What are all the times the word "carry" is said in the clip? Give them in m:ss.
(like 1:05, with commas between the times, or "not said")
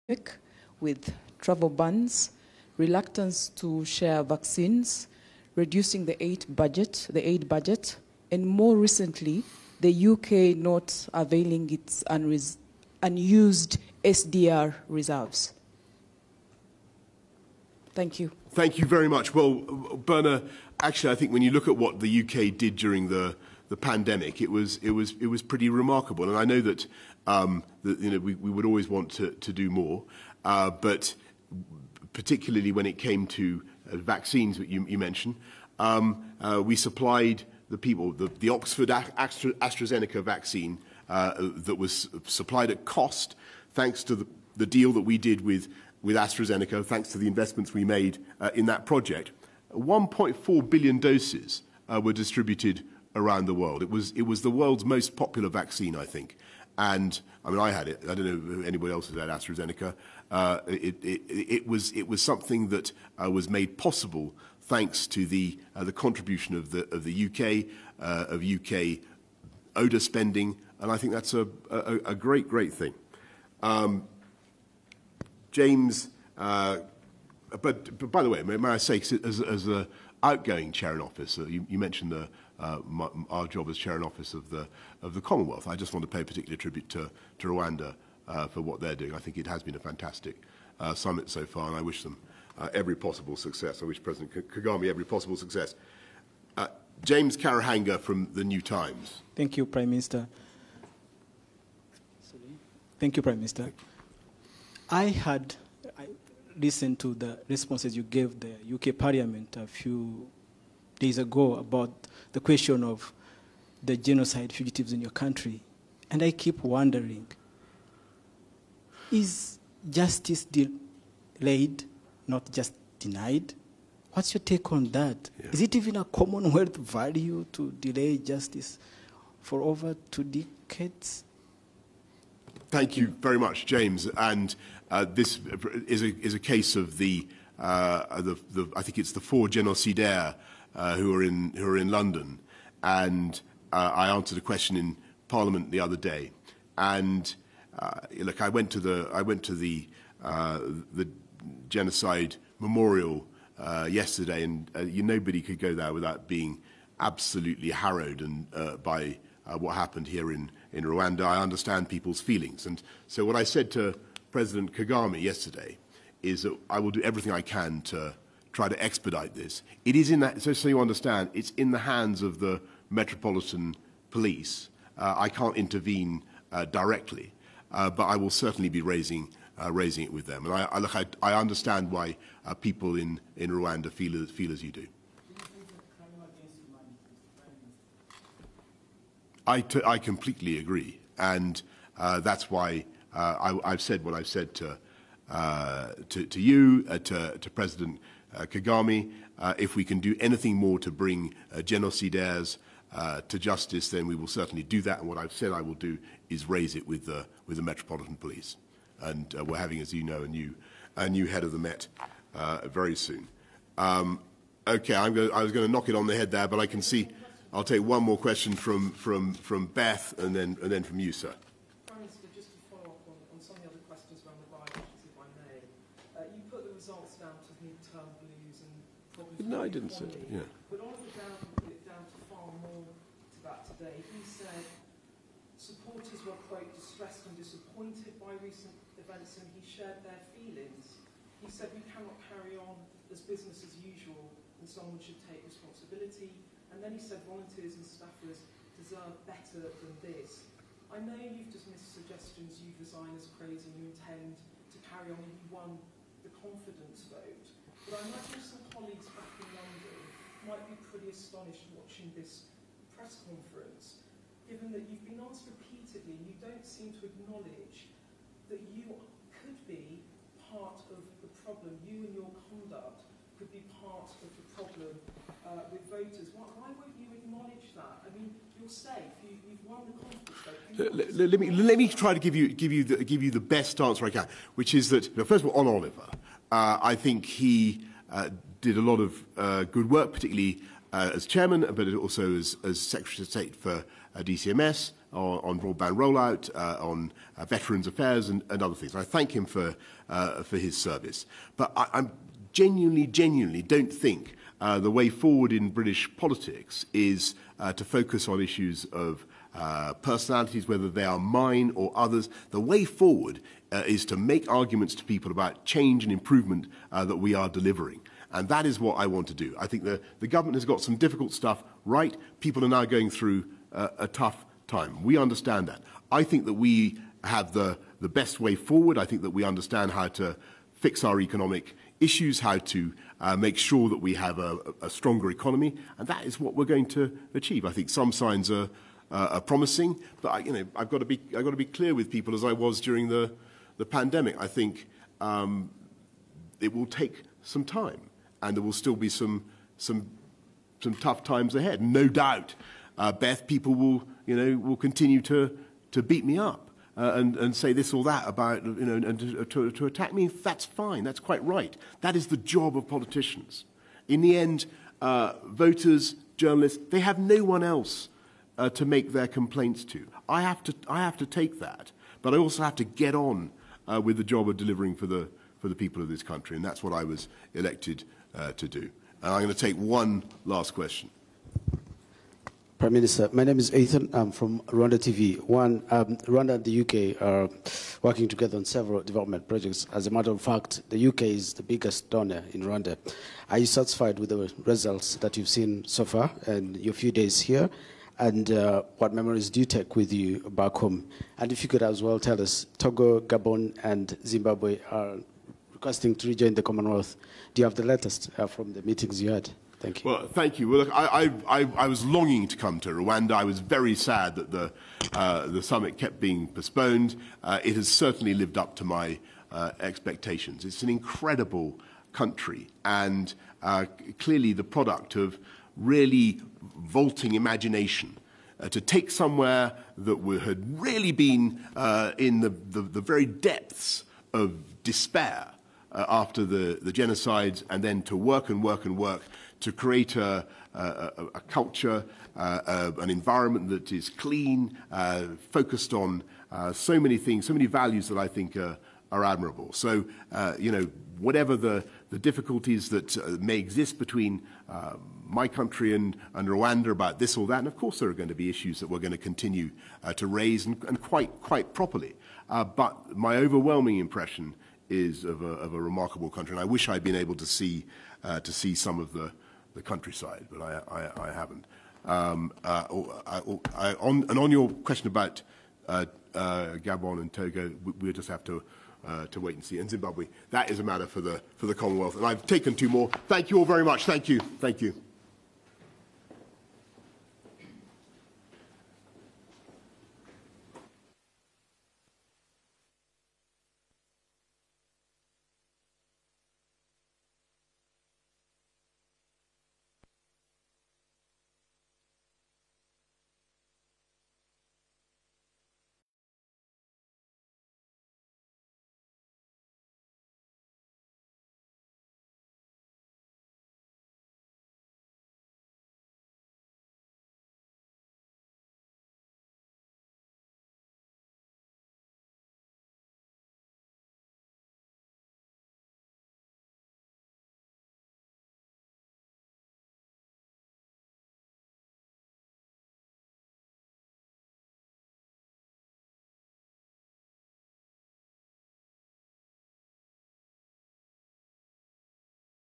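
4:02, 4:14.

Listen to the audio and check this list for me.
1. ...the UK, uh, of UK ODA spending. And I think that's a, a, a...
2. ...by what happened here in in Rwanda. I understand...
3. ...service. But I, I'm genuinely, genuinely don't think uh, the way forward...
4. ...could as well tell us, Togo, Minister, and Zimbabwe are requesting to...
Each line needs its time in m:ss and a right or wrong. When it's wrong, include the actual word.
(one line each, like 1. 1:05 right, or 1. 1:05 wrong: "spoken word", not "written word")
1. 1:07 right
2. 2:38 right
3. 5:00 right
4. 6:41 wrong: "Gabon", not "Minister".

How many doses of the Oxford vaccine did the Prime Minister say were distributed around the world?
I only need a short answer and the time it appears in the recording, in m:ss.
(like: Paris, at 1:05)
1.4 billion, at 0:49.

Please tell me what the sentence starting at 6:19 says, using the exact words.
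And I'm going to take one last question.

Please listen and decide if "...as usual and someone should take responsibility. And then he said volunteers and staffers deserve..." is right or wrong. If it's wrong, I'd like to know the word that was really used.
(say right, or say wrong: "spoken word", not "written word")
right.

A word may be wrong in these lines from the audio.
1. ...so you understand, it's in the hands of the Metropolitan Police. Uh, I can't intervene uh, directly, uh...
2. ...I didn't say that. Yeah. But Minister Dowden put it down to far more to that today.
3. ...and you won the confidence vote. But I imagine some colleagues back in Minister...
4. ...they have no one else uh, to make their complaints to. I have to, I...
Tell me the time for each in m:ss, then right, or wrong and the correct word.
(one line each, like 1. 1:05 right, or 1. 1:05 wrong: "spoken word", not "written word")
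1. 2:50 right
2. 3:49 wrong: "Oliver", not "Minister"
3. 4:15 wrong: "London", not "Minister"
4. 6:06 right.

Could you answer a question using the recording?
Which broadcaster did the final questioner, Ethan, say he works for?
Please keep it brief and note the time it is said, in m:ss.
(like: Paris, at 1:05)
Rwanda TV, at 6:24.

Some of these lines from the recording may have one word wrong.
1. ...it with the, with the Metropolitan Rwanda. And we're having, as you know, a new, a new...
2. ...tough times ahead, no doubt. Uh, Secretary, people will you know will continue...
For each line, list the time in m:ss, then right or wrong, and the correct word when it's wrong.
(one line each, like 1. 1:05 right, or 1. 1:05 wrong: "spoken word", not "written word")
1. 3:26 wrong: "Police", not "Rwanda"
2. 5:50 wrong: "Beth", not "Secretary".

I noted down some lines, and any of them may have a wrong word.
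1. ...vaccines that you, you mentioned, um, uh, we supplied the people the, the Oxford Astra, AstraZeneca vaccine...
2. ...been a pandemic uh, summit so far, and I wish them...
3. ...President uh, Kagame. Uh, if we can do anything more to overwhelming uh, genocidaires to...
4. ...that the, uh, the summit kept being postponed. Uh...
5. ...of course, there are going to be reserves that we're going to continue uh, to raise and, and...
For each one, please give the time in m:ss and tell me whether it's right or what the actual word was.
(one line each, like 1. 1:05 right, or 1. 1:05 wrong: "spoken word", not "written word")
1. 0:33 right
2. 1:29 wrong: "fantastic", not "pandemic"
3. 3:17 wrong: "bring", not "overwhelming"
4. 6:54 right
5. 7:37 wrong: "issues", not "reserves".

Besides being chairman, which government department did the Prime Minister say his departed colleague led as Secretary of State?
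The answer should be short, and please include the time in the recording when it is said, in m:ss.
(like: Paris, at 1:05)
DCMS, at 4:54.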